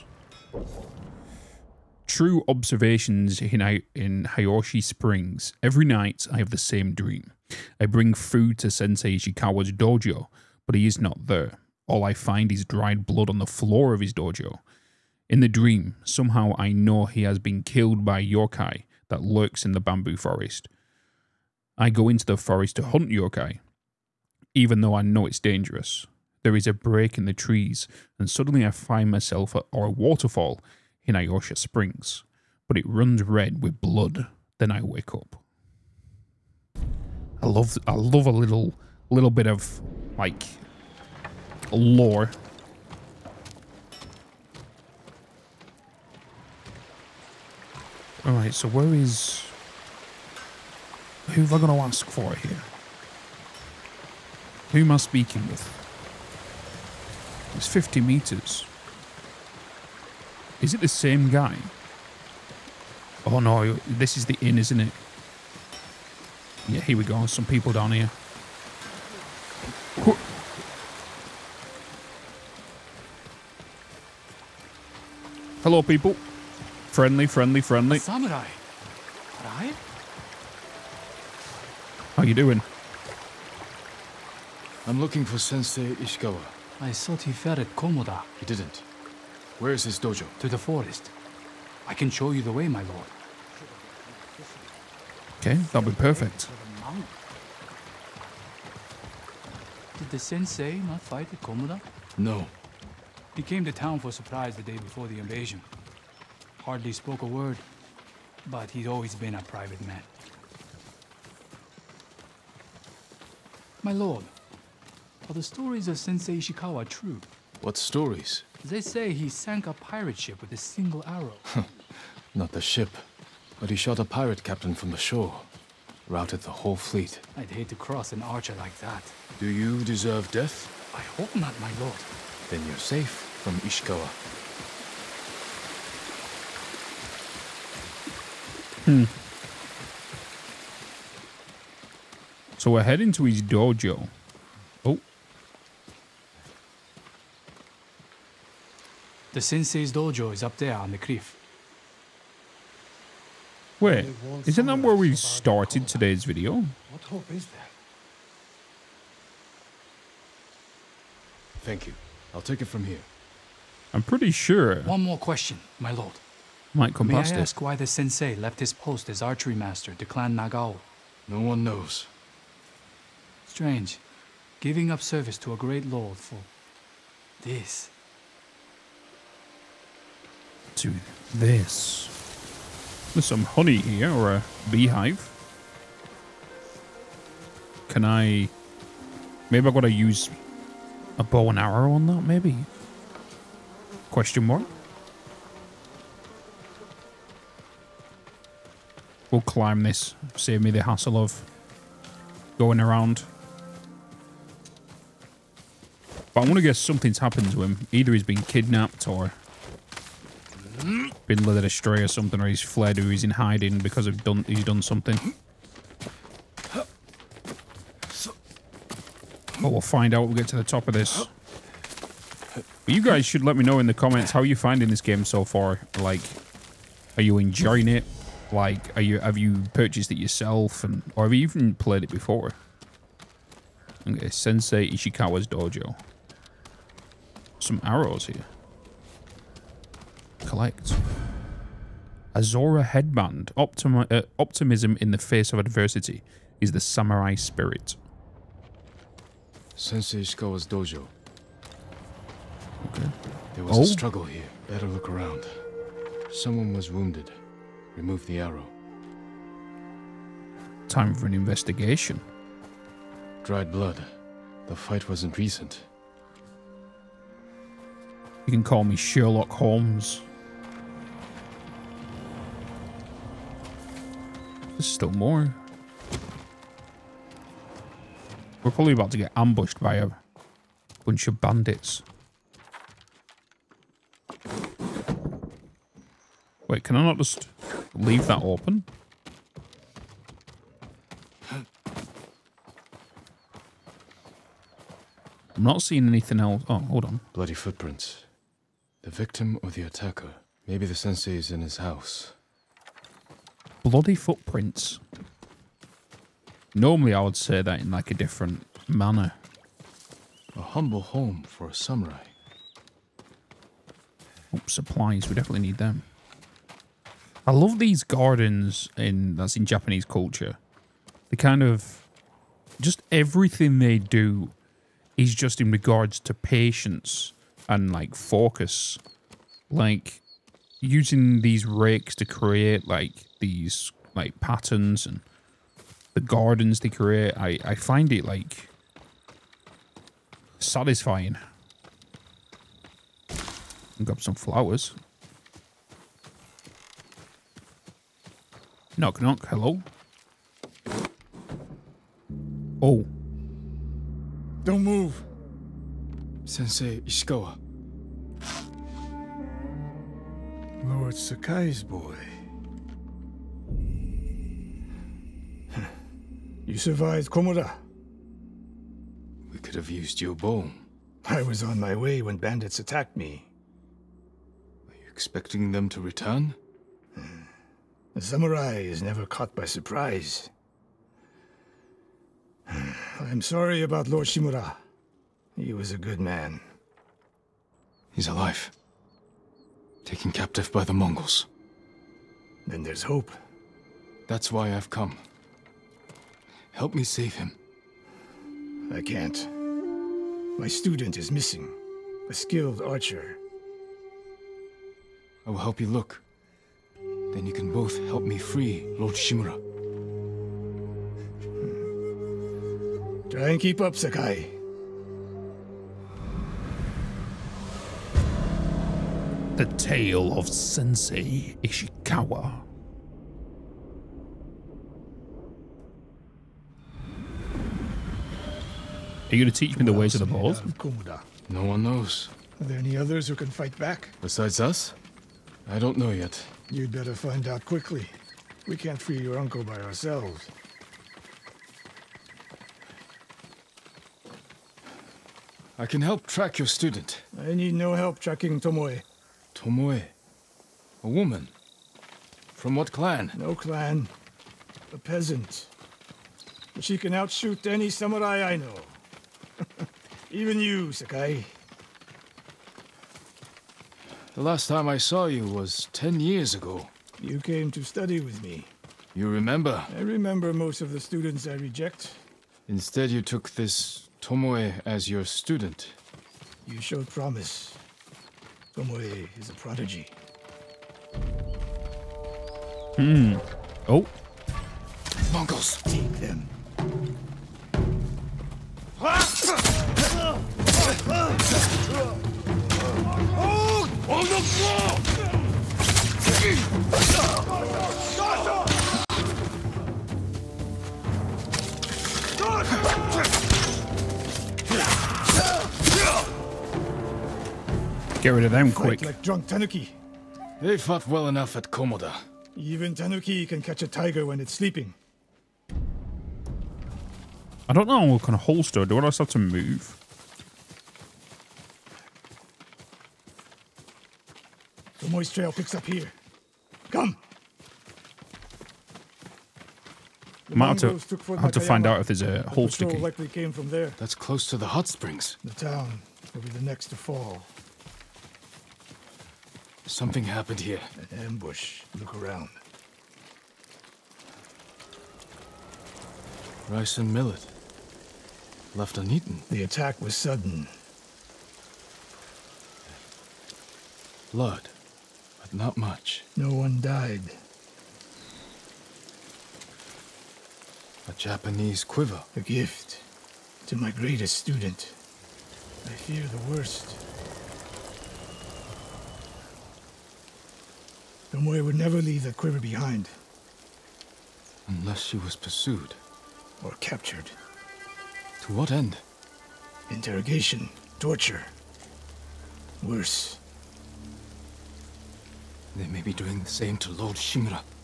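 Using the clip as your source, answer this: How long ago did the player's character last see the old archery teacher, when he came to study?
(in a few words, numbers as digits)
10 years.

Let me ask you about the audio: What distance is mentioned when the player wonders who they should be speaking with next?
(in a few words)
50 metres.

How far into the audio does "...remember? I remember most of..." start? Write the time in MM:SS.
07:49.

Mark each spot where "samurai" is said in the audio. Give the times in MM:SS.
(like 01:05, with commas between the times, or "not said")
01:17, 04:06, 05:11, 06:18, 07:37.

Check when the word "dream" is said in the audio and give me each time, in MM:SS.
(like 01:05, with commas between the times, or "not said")
00:06, 00:15.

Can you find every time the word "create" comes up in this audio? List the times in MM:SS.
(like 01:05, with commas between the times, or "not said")
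05:32, 05:36.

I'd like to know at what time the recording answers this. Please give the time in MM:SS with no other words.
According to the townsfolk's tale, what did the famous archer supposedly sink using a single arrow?
01:59.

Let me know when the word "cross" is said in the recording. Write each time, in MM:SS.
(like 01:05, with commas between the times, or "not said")
02:07.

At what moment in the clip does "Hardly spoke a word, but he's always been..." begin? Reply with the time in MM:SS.
01:46.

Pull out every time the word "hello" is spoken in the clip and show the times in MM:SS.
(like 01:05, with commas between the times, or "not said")
01:15, 05:49.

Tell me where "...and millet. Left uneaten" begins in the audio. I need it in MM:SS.
09:06.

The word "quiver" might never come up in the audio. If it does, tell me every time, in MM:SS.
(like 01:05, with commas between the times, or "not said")
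09:21, 09:32.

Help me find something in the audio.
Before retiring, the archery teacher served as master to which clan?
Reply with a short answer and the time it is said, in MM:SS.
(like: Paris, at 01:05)
Clan Nagao, at 02:50.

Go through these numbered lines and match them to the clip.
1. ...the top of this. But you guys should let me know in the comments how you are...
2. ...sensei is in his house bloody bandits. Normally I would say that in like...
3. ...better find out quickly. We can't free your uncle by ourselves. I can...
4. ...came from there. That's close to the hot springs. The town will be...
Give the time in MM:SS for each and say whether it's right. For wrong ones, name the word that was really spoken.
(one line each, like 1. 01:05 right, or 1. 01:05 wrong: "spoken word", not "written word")
1. 03:40 right
2. 05:00 wrong: "footprints", not "bandits"
3. 07:16 right
4. 08:53 right.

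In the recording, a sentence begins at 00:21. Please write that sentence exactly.
I go into the forest to hunt yokai, even though I know it's dangerous.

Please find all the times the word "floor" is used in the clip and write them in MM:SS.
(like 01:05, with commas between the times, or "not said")
00:13, 08:14.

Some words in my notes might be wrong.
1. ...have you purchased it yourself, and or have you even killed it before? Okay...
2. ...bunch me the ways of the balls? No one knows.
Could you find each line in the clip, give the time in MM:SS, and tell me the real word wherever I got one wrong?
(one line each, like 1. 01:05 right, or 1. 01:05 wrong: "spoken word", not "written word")
1. 03:49 wrong: "played", not "killed"
2. 07:09 wrong: "teach", not "bunch".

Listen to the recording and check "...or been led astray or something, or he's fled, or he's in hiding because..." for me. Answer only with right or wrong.
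right.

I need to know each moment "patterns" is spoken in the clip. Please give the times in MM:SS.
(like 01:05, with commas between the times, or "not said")
05:34.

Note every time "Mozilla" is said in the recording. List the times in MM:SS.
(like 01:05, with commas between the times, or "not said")
not said.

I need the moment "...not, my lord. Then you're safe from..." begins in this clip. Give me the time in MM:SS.
02:11.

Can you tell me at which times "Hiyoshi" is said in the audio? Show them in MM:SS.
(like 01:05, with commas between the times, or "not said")
00:04, 00:31.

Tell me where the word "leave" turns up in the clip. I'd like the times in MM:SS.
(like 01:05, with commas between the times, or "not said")
04:47, 09:32.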